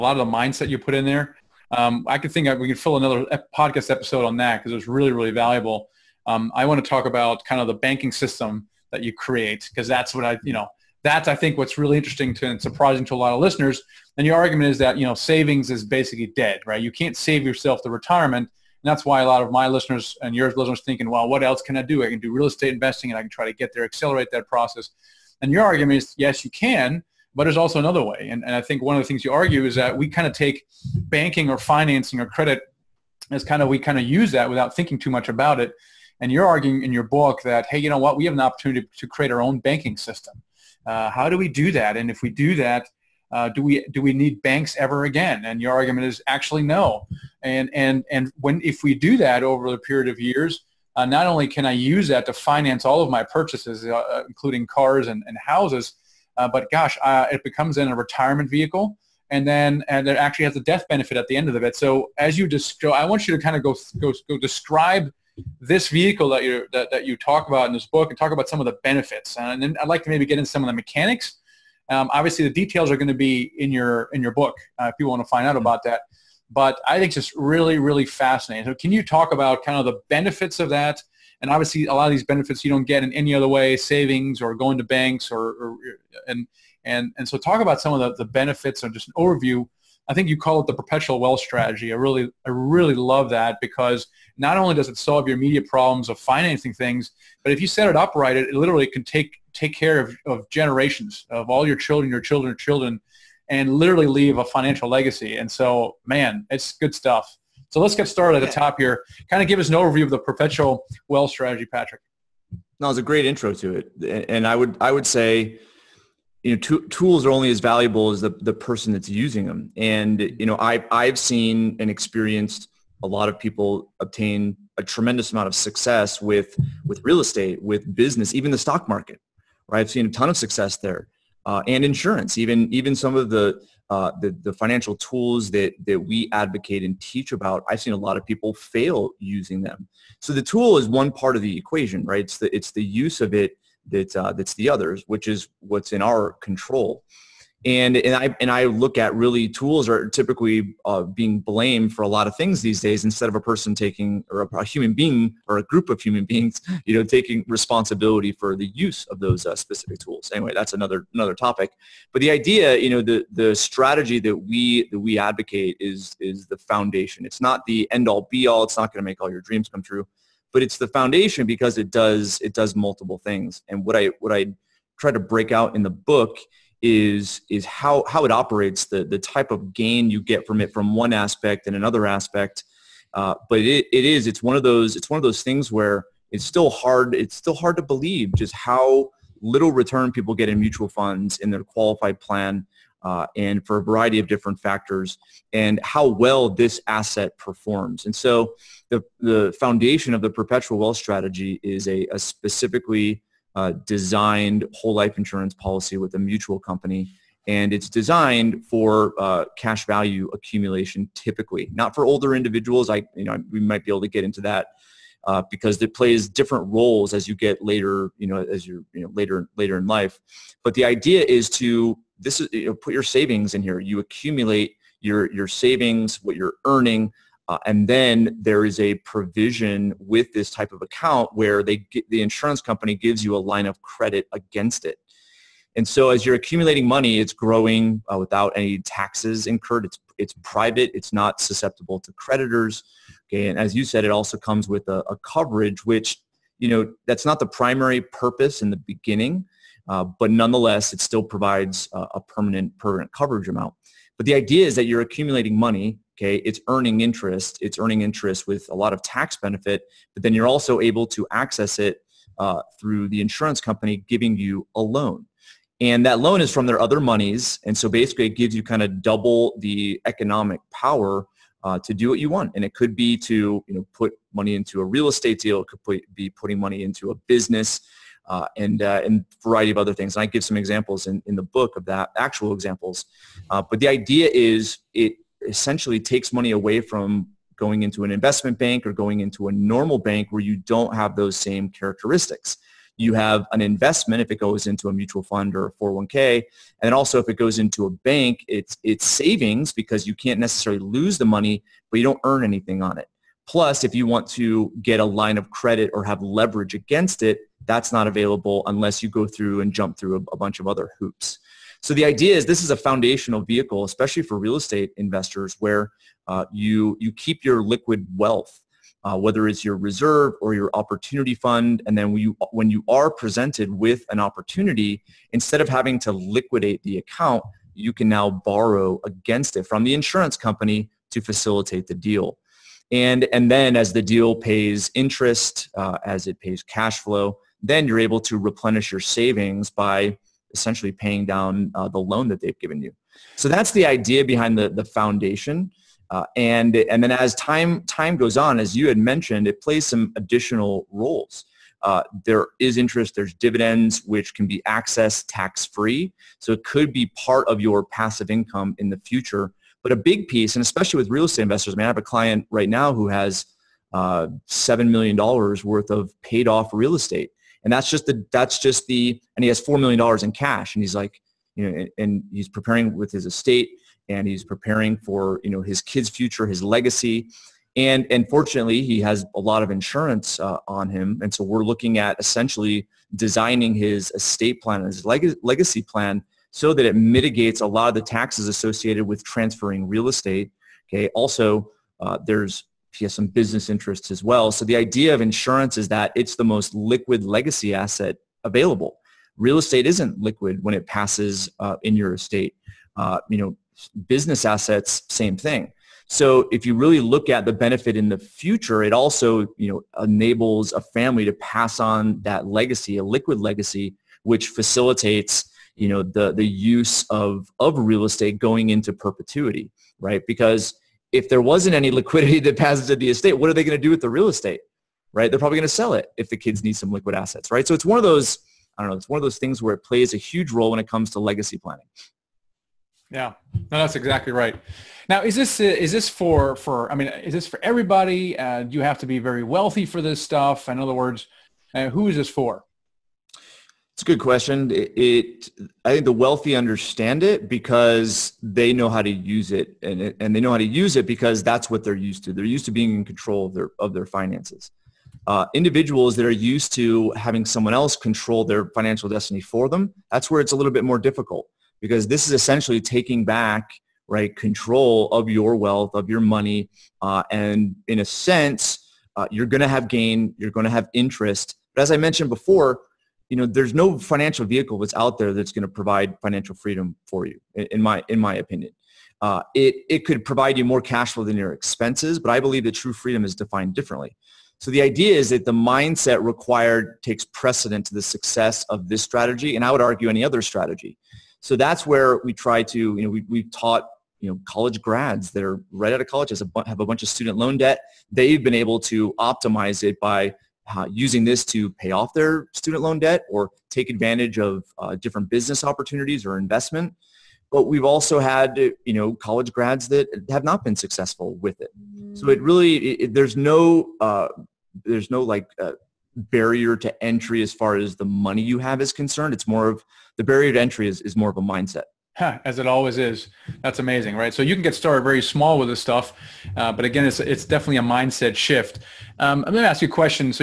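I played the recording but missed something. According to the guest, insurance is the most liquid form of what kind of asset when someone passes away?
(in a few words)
legacy asset.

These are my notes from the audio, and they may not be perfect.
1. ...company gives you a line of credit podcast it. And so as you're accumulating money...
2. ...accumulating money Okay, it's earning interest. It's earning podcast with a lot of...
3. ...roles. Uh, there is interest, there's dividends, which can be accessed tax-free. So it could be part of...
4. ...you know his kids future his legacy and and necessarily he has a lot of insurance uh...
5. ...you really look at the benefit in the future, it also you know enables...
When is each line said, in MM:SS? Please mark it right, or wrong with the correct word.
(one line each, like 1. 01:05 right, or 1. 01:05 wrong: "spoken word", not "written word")
1. 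03:52 wrong: "against", not "podcast"
2. 04:14 wrong: "interest", not "podcast"
3. 05:50 right
4. 06:15 wrong: "fortunately", not "necessarily"
5. 06:46 right.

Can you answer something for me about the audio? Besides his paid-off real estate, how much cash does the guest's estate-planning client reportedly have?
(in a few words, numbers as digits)
4 million dollars.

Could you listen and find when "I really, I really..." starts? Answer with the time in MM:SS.
01:31.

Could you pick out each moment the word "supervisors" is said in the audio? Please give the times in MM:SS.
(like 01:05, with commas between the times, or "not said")
not said.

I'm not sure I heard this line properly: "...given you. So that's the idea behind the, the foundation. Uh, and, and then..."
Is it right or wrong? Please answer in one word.
right.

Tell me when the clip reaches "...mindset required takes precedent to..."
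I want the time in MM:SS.
08:05.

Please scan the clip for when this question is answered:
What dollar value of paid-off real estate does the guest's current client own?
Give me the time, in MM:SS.
06:04.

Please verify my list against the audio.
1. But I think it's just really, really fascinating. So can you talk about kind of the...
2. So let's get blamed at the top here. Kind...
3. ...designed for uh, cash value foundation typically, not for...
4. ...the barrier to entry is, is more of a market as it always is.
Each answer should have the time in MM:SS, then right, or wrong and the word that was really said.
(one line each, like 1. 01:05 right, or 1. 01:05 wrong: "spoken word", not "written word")
1. 01:16 right
2. 01:47 wrong: "started", not "blamed"
3. 03:27 wrong: "accumulation", not "foundation"
4. 08:40 wrong: "mindset", not "market".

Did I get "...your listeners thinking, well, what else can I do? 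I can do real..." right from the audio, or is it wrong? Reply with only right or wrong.
right.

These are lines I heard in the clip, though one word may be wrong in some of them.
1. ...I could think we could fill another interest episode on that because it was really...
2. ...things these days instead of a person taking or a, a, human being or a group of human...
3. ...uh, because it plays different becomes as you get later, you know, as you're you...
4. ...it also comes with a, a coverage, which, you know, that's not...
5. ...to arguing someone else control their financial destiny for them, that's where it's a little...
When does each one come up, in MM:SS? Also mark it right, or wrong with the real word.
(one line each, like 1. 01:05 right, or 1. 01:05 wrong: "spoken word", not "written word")
1. 00:02 wrong: "podcast", not "interest"
2. 02:32 right
3. 03:35 wrong: "roles", not "becomes"
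4. 04:04 right
5. 07:36 wrong: "having", not "arguing".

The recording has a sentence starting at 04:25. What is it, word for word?
And that loan is from their other monies.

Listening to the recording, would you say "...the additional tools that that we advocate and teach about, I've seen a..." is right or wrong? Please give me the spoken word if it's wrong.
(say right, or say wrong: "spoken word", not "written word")
wrong: "financial", not "additional".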